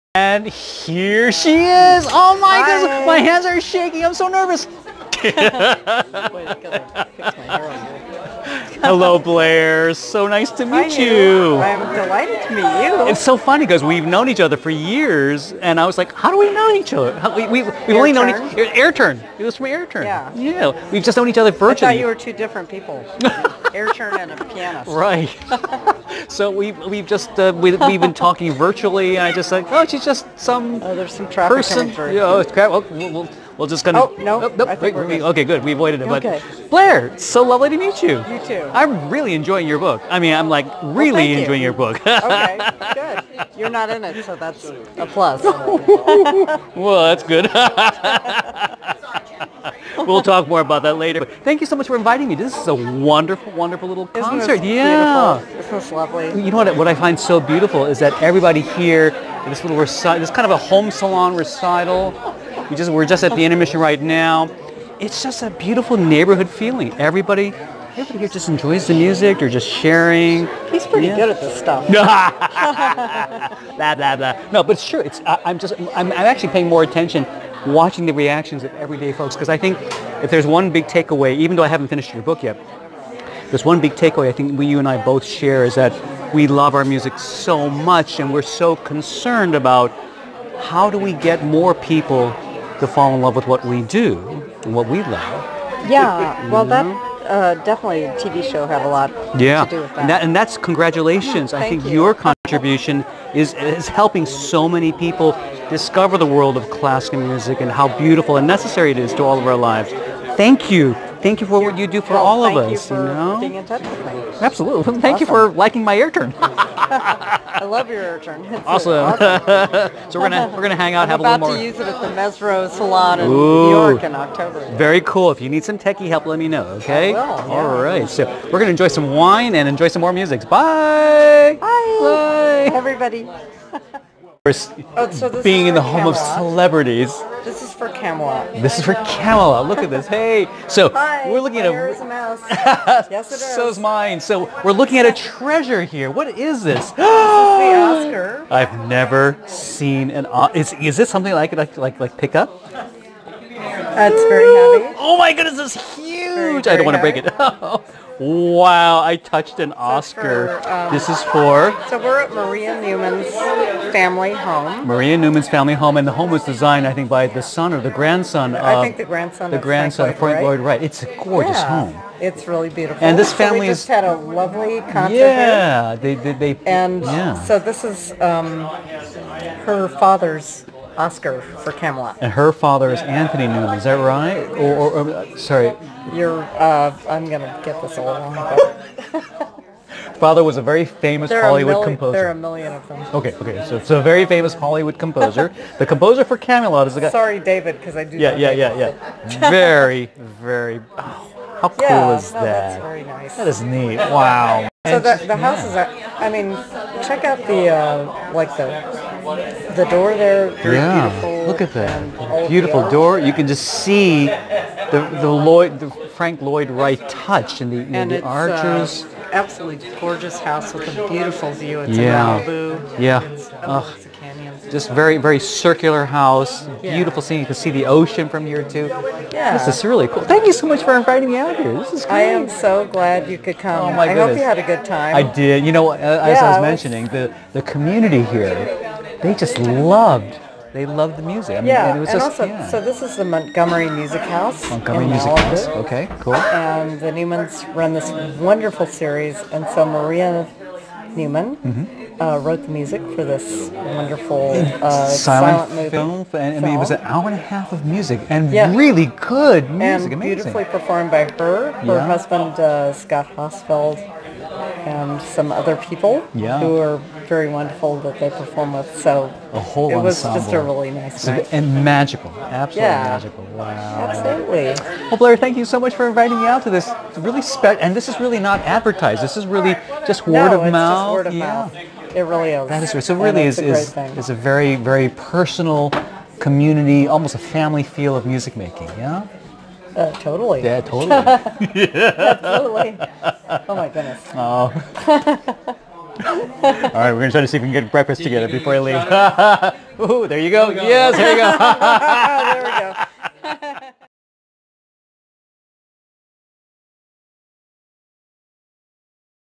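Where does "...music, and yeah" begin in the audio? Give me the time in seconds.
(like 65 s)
257 s.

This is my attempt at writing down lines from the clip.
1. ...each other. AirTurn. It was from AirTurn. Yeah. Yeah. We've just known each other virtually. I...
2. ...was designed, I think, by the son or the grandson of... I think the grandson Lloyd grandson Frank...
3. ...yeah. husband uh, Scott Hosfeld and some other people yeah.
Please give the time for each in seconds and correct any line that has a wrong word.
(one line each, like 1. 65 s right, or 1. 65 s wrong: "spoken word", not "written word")
1. 18 s right
2. 166 s wrong: "The", not "Lloyd"
3. 261 s right.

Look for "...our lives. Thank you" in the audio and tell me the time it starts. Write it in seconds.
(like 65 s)
109 s.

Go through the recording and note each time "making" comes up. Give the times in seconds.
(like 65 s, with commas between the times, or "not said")
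288 s.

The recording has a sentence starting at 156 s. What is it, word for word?
Very, very I don't want to break it.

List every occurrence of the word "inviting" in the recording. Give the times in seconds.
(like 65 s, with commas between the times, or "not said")
51 s, 230 s, 276 s.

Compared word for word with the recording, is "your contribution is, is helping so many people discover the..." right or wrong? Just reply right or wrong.
right.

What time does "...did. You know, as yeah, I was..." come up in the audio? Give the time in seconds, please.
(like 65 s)
235 s.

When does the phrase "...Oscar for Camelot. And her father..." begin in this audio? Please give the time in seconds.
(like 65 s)
180 s.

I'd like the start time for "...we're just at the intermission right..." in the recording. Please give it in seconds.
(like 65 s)
62 s.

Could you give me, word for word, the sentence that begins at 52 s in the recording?
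This is a wonderful, wonderful little Isn't concert.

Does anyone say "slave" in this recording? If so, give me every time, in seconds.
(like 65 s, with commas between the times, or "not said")
not said.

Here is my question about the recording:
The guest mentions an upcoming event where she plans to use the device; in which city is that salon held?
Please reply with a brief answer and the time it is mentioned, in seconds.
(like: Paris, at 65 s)
New York, at 123 s.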